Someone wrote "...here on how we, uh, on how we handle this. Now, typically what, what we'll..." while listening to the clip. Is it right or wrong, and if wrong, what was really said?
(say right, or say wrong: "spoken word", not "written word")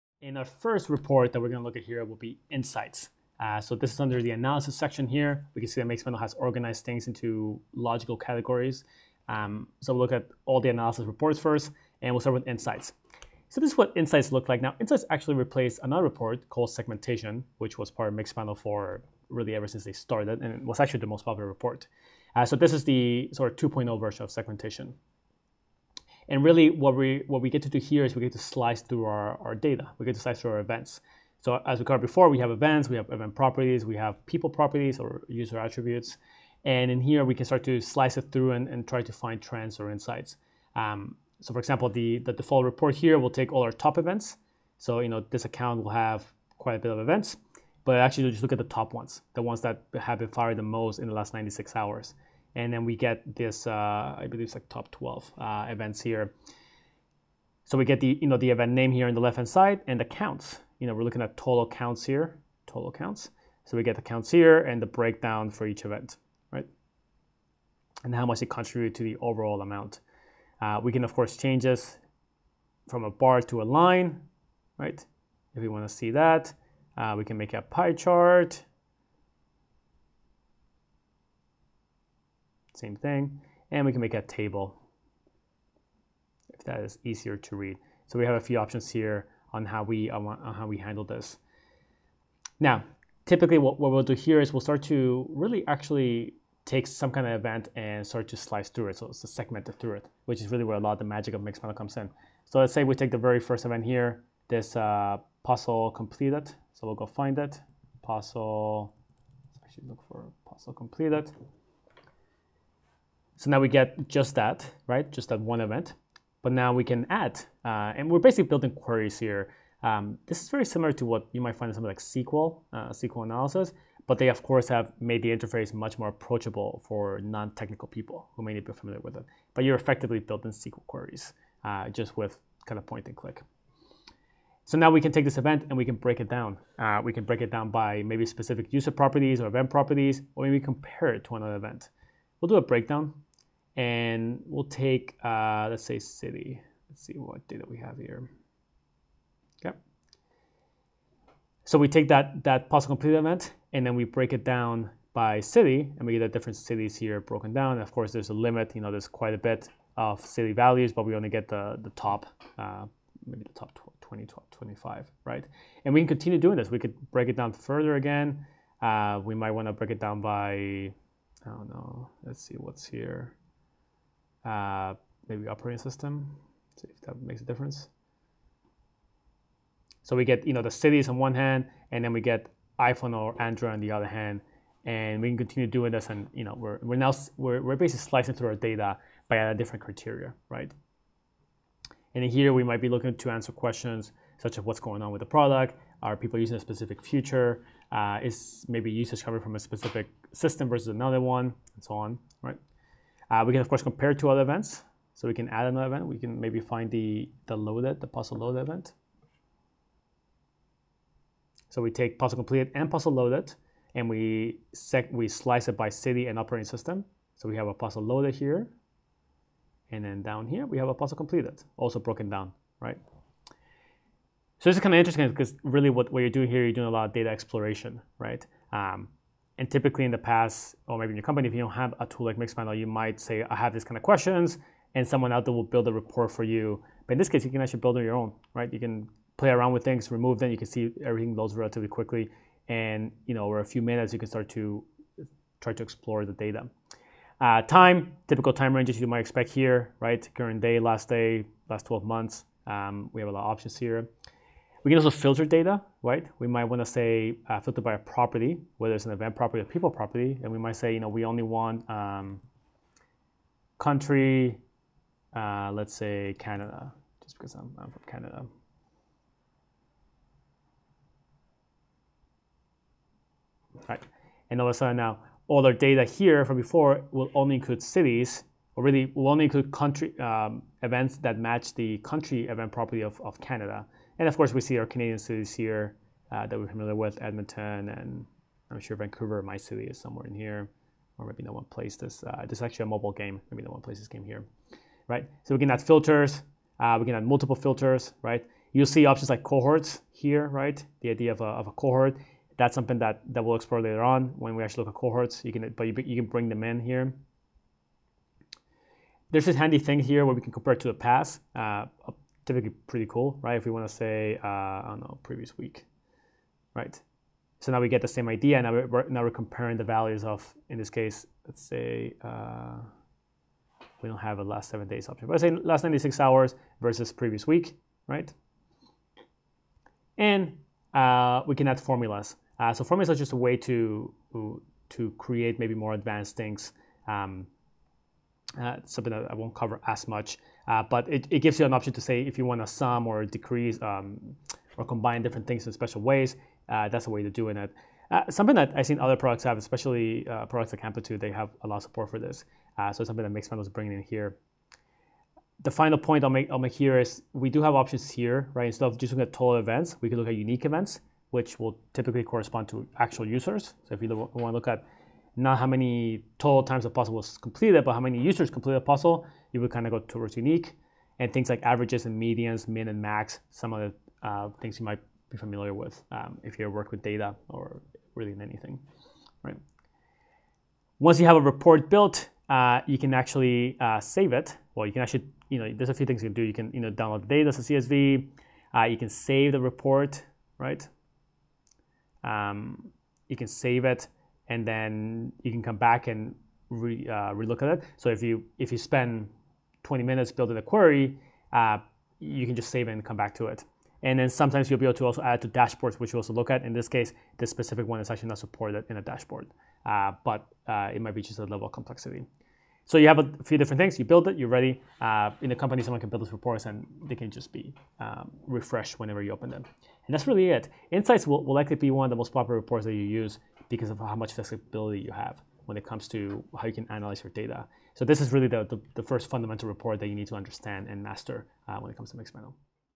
right.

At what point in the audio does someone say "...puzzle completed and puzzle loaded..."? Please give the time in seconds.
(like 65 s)
212 s.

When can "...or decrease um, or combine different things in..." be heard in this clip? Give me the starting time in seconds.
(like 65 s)
343 s.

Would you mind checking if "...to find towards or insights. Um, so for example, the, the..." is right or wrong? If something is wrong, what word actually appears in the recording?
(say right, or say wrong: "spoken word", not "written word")
wrong: "trends", not "towards".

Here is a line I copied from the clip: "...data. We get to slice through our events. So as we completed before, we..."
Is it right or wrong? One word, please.
wrong.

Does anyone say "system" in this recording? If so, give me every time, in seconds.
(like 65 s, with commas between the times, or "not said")
175 s, 200 s, 216 s.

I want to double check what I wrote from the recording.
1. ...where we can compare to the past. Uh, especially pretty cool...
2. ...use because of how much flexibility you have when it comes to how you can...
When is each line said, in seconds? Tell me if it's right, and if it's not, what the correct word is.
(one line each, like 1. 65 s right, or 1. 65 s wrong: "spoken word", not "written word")
1. 310 s wrong: "typically", not "especially"
2. 423 s right.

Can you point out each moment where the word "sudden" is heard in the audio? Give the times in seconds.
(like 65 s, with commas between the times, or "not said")
274 s.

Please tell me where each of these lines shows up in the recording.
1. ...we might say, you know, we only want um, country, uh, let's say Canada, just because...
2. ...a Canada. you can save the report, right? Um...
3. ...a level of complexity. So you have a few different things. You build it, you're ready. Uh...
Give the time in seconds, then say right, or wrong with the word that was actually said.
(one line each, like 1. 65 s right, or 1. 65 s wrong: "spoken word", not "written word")
1. 260 s right
2. 387 s wrong: "CSV", not "Canada"
3. 411 s right.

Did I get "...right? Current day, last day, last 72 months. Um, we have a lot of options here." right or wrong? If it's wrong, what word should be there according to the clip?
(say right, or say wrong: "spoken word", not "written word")
wrong: "12", not "72".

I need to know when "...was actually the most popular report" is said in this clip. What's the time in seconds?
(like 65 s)
20 s.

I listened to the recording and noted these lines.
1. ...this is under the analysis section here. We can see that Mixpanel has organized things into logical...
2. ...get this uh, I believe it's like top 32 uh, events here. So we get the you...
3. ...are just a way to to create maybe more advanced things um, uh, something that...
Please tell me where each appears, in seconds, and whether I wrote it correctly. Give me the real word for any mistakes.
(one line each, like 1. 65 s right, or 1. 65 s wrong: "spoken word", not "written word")
1. 3 s right
2. 52 s wrong: "12", not "32"
3. 333 s right.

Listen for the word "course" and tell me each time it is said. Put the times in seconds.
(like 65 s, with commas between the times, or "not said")
71 s, 124 s, 157 s, 203 s, 284 s.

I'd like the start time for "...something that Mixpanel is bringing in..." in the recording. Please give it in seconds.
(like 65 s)
353 s.